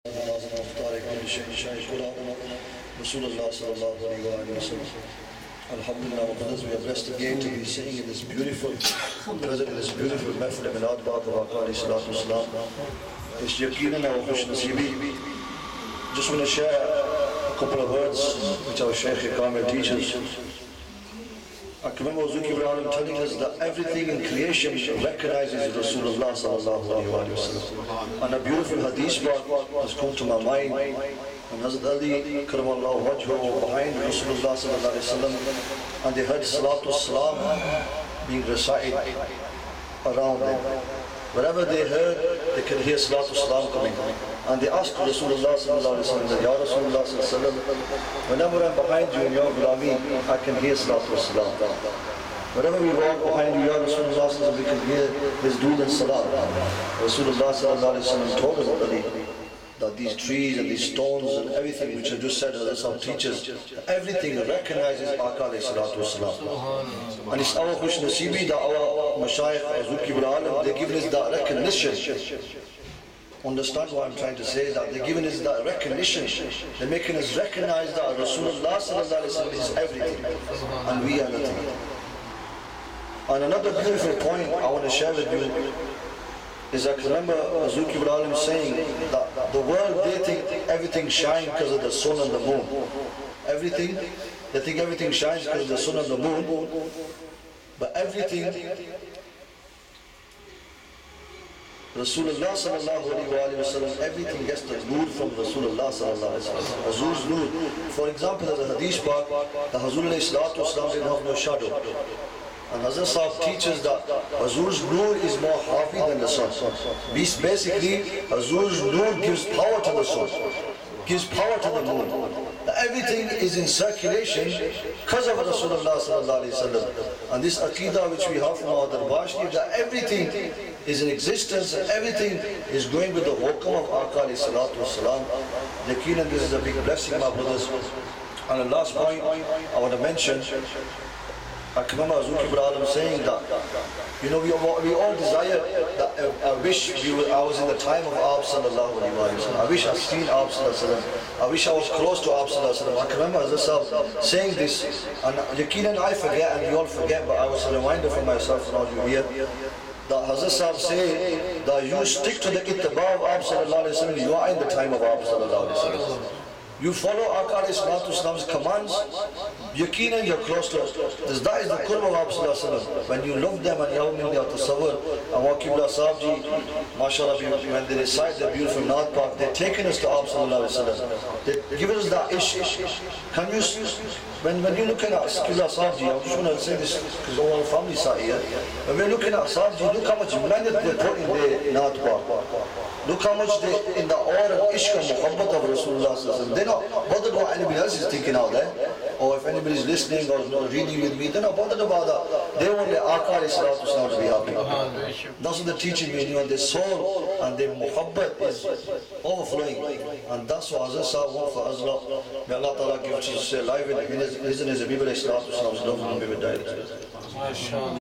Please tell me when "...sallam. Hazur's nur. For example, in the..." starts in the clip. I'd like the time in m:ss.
1:46.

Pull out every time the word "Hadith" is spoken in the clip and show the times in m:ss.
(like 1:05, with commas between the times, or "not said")
1:48.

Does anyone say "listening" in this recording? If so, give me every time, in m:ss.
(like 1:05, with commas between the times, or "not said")
3:19.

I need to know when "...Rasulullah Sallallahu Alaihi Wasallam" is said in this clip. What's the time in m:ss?
3:15.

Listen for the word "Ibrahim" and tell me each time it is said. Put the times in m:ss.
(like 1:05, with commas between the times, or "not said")
1:10, 1:27.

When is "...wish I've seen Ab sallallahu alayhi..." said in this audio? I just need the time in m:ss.
2:29.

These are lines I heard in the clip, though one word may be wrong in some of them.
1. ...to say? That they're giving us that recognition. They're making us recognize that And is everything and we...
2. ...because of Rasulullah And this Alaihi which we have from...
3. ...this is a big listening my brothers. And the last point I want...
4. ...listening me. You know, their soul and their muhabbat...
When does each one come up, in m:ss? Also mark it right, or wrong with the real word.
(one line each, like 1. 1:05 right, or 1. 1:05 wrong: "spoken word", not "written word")
1. 1:14 wrong: "Rasulullah", not "And"
2. 2:05 wrong: "Aqidah", not "Alaihi"
3. 2:16 wrong: "blessing", not "listening"
4. 3:25 wrong: "teaching", not "listening".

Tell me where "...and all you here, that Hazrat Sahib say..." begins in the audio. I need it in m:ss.
2:38.